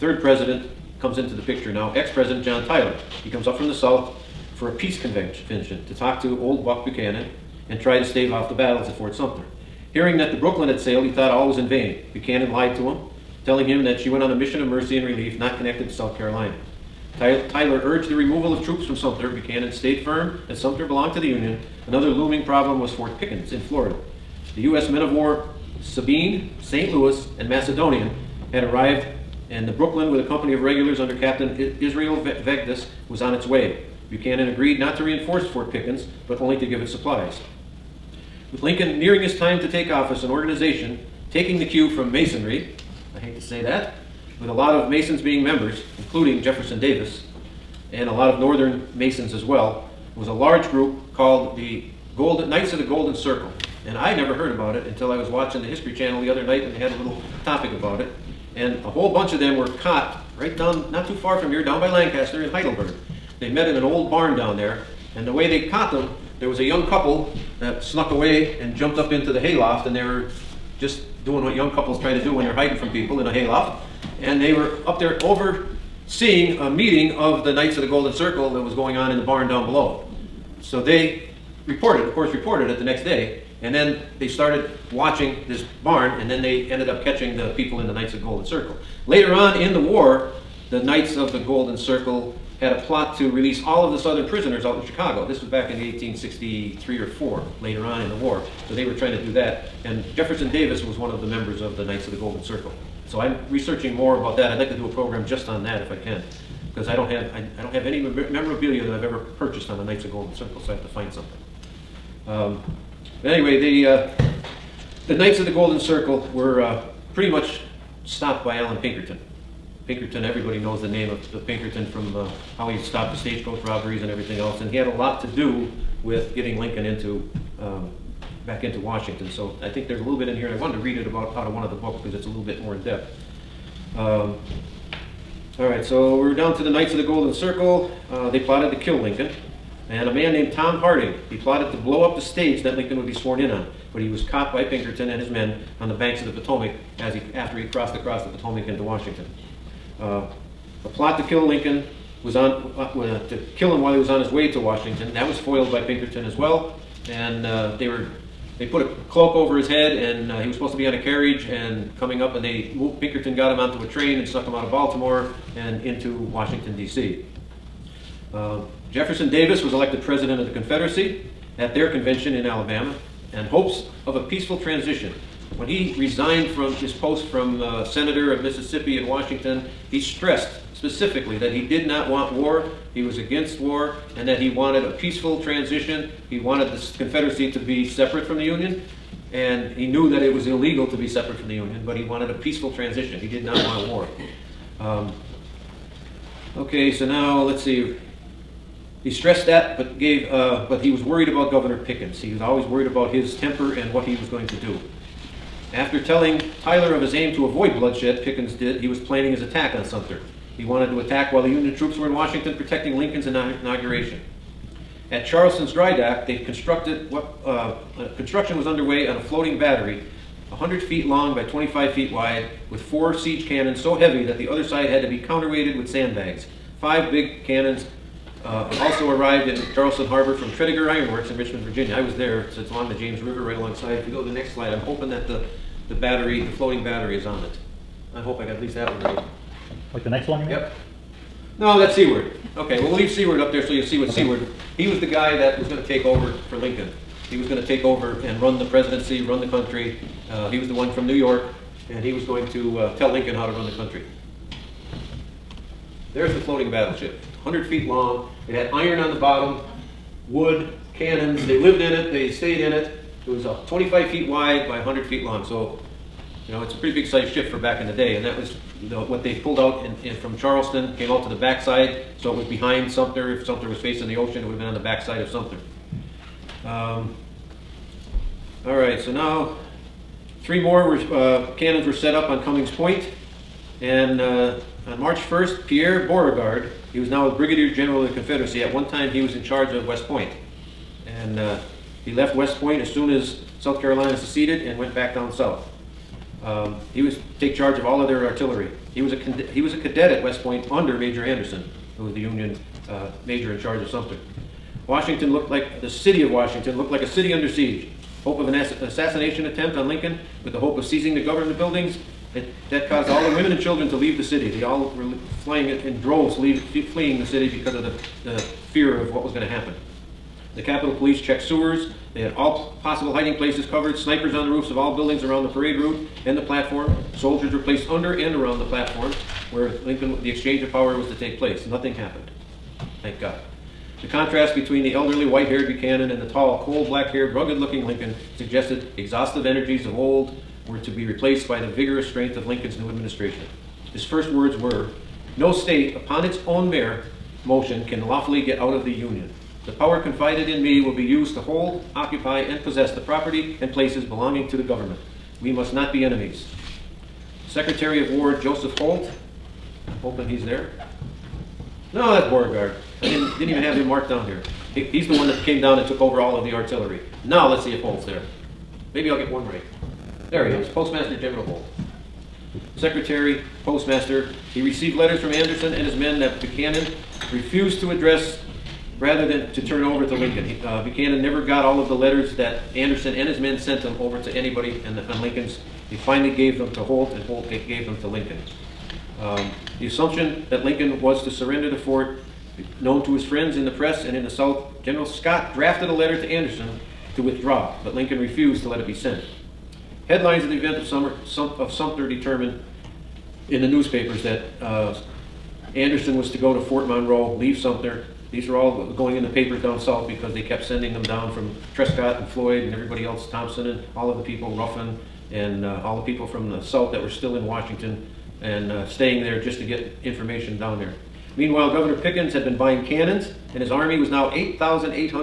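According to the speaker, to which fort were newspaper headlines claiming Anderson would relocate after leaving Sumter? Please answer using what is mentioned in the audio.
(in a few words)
Fort Monroe.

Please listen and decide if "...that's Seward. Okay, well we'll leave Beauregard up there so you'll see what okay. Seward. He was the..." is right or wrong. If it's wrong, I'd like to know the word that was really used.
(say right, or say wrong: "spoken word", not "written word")
wrong: "Seward", not "Beauregard".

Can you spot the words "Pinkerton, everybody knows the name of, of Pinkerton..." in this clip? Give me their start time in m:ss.
1:59.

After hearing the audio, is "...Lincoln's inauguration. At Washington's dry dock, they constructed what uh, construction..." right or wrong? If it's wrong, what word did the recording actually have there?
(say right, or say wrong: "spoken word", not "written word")
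wrong: "Charleston", not "Washington".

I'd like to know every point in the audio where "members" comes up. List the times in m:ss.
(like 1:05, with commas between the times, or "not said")
0:45, 1:41.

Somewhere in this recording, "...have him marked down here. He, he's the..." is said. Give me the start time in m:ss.
6:03.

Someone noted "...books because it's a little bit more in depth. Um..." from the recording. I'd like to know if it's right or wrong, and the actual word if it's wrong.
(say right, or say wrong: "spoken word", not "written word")
right.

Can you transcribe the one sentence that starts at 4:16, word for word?
There's the floating battleship, 100 feet long.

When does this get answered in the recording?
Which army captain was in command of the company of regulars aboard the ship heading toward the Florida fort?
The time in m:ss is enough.
0:31.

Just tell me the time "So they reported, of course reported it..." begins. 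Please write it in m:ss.
1:20.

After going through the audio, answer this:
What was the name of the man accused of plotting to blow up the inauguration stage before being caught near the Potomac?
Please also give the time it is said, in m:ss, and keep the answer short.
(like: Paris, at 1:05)
Tom Harding, at 2:20.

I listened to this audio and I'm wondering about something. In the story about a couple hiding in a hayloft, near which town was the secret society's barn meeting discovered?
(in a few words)
Heidelberg.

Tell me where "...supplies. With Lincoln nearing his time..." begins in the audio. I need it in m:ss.
0:36.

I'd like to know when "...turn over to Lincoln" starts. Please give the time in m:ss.
6:19.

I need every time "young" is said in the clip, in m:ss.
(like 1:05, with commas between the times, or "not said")
1:06, 1:11.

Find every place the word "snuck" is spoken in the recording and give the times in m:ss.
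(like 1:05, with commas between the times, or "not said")
1:07, 2:44.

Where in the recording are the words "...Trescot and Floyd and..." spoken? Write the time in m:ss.
6:51.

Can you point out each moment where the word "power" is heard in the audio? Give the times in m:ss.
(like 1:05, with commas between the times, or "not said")
5:30, 5:49.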